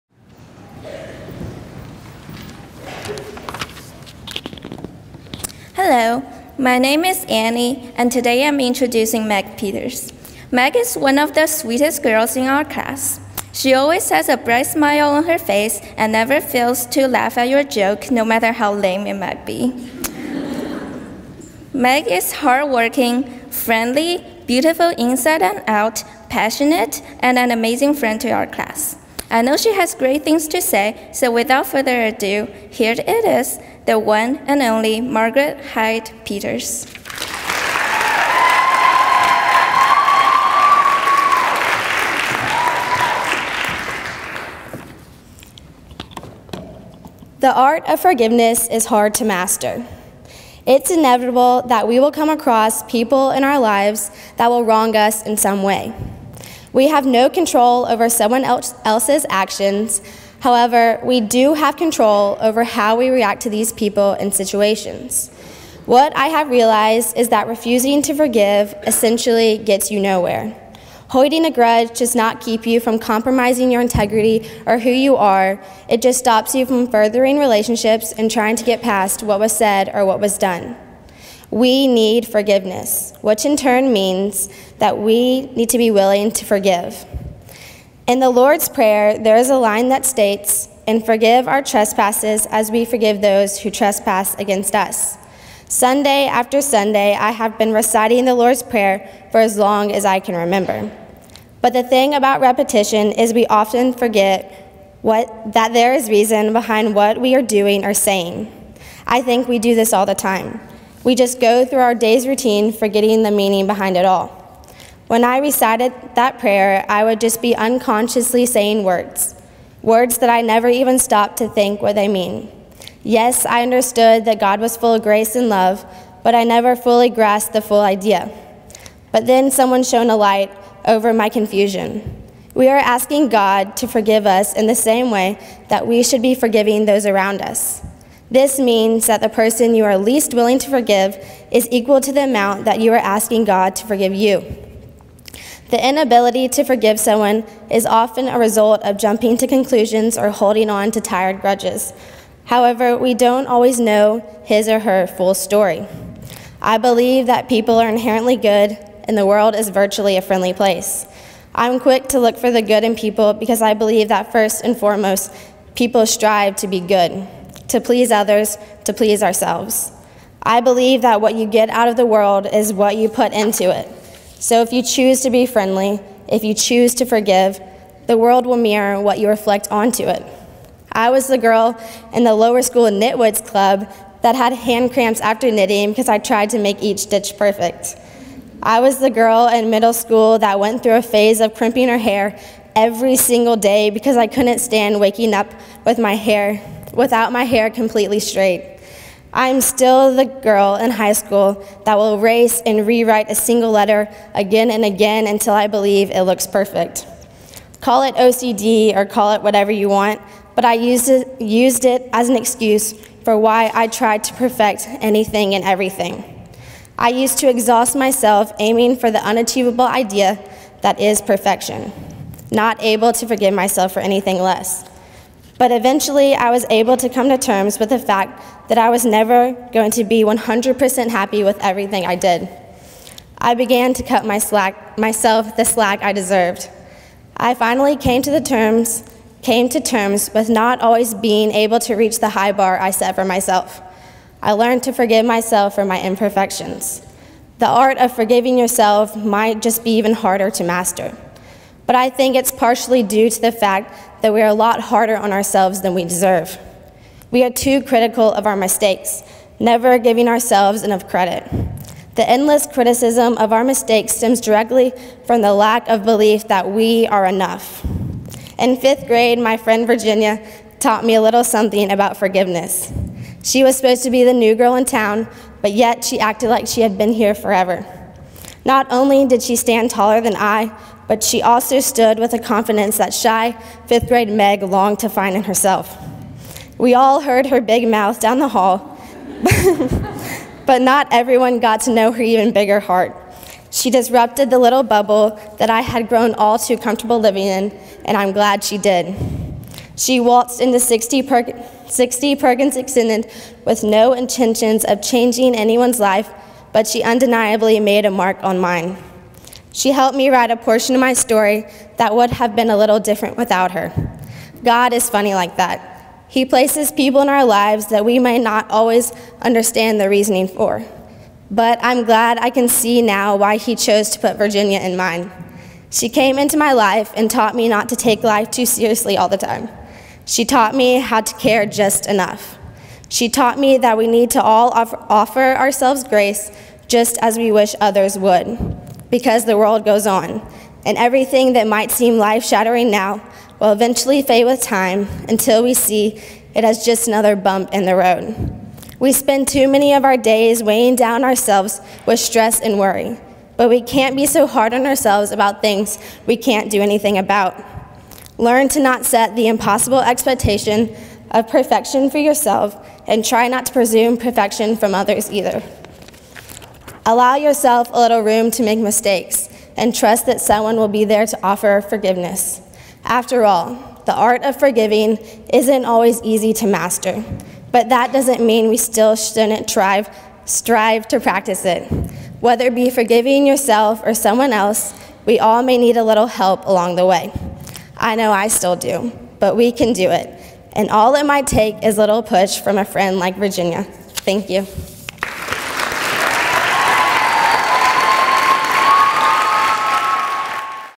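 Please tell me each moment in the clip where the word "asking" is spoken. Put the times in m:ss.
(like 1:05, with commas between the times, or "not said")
2:12, 2:22.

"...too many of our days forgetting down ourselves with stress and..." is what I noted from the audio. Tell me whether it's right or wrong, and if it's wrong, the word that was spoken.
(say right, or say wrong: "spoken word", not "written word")
wrong: "weighing", not "forgetting".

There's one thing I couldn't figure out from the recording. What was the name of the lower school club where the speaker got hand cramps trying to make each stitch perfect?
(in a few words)
Knitwoods Club.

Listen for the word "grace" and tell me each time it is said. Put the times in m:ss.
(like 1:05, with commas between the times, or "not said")
2:05, 5:36.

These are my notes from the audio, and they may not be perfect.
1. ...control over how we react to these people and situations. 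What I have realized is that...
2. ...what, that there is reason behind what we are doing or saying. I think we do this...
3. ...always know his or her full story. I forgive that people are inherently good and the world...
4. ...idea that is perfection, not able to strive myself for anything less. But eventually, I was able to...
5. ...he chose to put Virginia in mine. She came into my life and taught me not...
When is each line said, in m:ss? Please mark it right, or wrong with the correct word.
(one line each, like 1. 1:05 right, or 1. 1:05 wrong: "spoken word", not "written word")
1. 1:01 right
2. 1:45 right
3. 2:33 wrong: "believe", not "forgive"
4. 3:39 wrong: "forgive", not "strive"
5. 5:23 right.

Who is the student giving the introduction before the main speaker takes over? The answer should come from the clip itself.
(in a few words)
Annie.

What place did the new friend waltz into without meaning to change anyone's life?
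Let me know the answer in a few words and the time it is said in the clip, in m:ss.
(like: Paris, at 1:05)
60 Perkins Extended, at 5:01.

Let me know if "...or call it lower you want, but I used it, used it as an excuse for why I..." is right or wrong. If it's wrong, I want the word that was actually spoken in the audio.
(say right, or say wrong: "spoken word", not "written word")
wrong: "whatever", not "lower".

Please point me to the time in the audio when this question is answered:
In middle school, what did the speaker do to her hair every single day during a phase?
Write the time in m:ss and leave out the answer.
3:11.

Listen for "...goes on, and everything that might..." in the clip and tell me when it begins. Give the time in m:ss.
5:39.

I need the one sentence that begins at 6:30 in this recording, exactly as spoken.
And all it might take is a little push from a friend like Virginia.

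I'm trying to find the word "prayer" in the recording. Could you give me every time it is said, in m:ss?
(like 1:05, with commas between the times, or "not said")
1:28, 1:38, 1:56.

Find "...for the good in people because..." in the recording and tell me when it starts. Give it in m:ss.
2:42.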